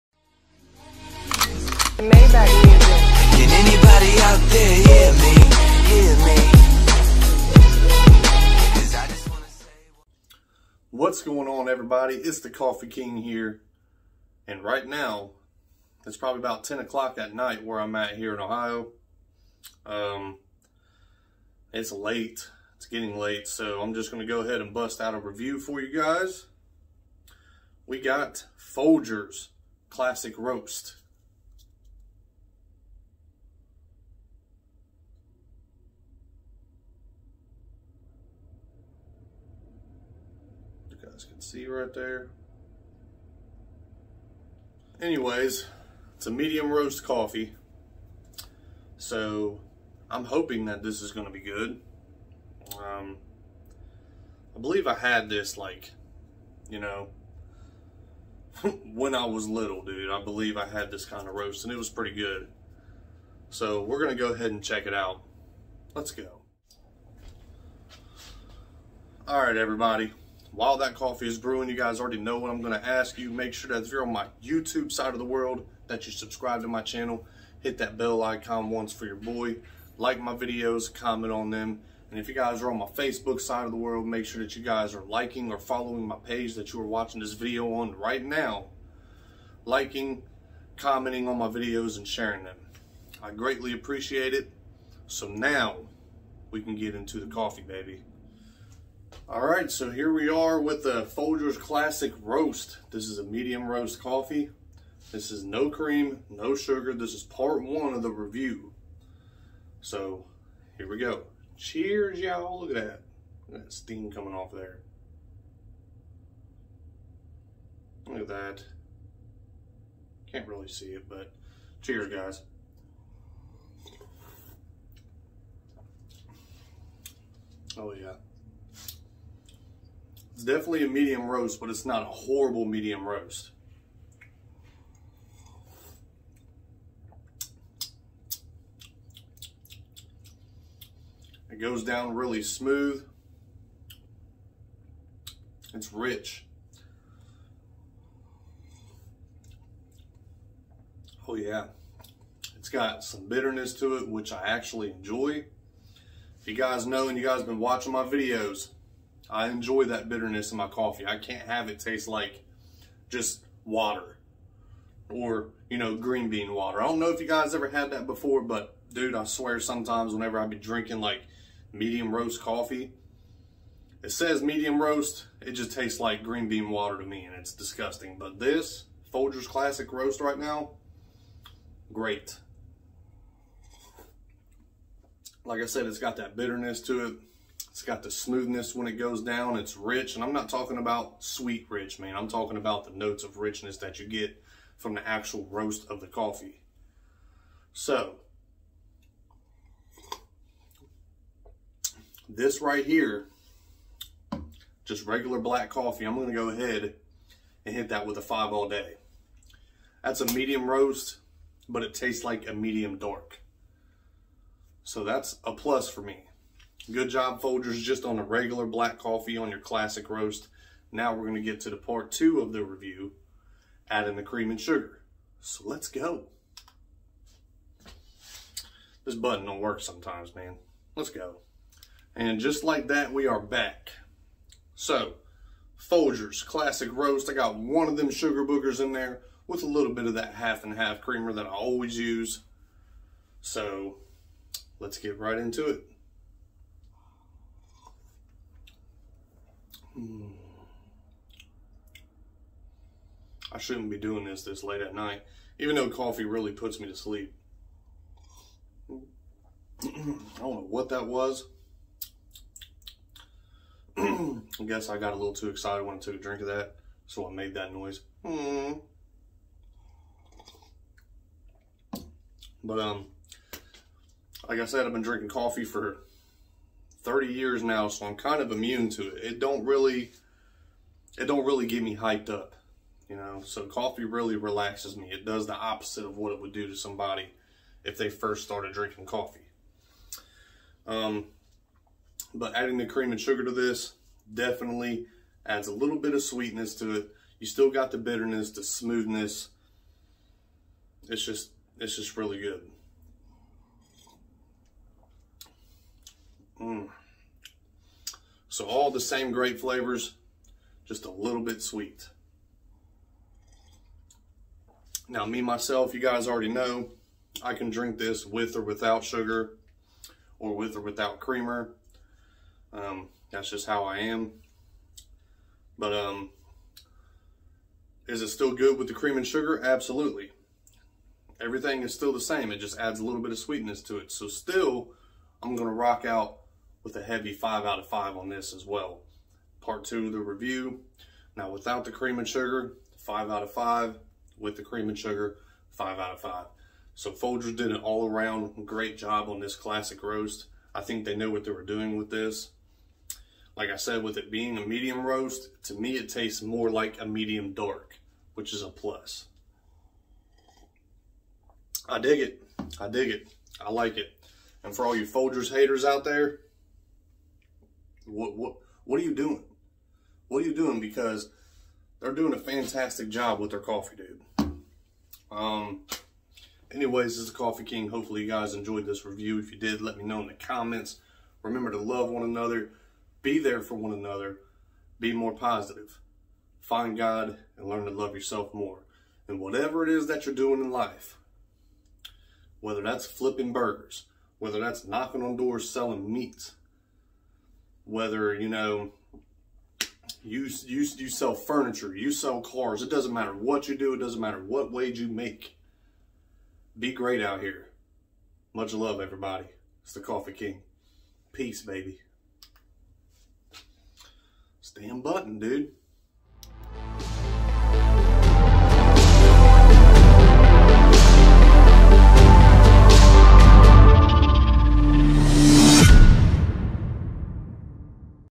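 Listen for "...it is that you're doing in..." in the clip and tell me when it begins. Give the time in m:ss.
6:29.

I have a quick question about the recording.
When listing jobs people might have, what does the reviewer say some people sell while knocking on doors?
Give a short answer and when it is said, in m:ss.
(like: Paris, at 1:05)
meats, at 6:36.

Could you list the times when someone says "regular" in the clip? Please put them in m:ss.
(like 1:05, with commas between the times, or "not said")
3:25, 3:38.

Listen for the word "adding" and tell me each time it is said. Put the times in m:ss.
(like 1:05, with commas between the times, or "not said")
3:43, 4:52.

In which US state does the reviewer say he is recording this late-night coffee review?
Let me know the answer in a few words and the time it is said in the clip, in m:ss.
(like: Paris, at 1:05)
Ohio, at 0:18.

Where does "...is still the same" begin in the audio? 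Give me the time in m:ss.
5:31.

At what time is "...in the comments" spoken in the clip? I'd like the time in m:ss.
6:20.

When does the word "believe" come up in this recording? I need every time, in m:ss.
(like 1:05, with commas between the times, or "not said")
0:54, 1:00.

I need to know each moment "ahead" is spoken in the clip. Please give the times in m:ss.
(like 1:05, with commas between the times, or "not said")
0:24, 1:04, 3:26.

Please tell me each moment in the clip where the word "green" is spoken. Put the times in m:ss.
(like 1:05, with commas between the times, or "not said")
2:45, 2:56.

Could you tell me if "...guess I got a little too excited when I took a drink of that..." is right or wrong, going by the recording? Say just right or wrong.
right.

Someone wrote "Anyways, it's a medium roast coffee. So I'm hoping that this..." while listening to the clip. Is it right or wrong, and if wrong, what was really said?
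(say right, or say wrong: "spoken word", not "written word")
right.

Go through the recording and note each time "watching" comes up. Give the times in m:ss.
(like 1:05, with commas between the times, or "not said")
1:26, 2:37.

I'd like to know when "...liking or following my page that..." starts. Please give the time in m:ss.
1:25.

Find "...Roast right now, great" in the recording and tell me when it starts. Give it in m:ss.
2:59.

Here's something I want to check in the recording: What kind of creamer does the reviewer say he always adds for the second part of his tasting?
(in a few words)
half and half.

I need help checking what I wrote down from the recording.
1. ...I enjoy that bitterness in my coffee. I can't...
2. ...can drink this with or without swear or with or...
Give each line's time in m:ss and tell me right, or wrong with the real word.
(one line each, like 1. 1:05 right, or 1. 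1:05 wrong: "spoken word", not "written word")
1. 2:39 right
2. 5:17 wrong: "sugar", not "swear".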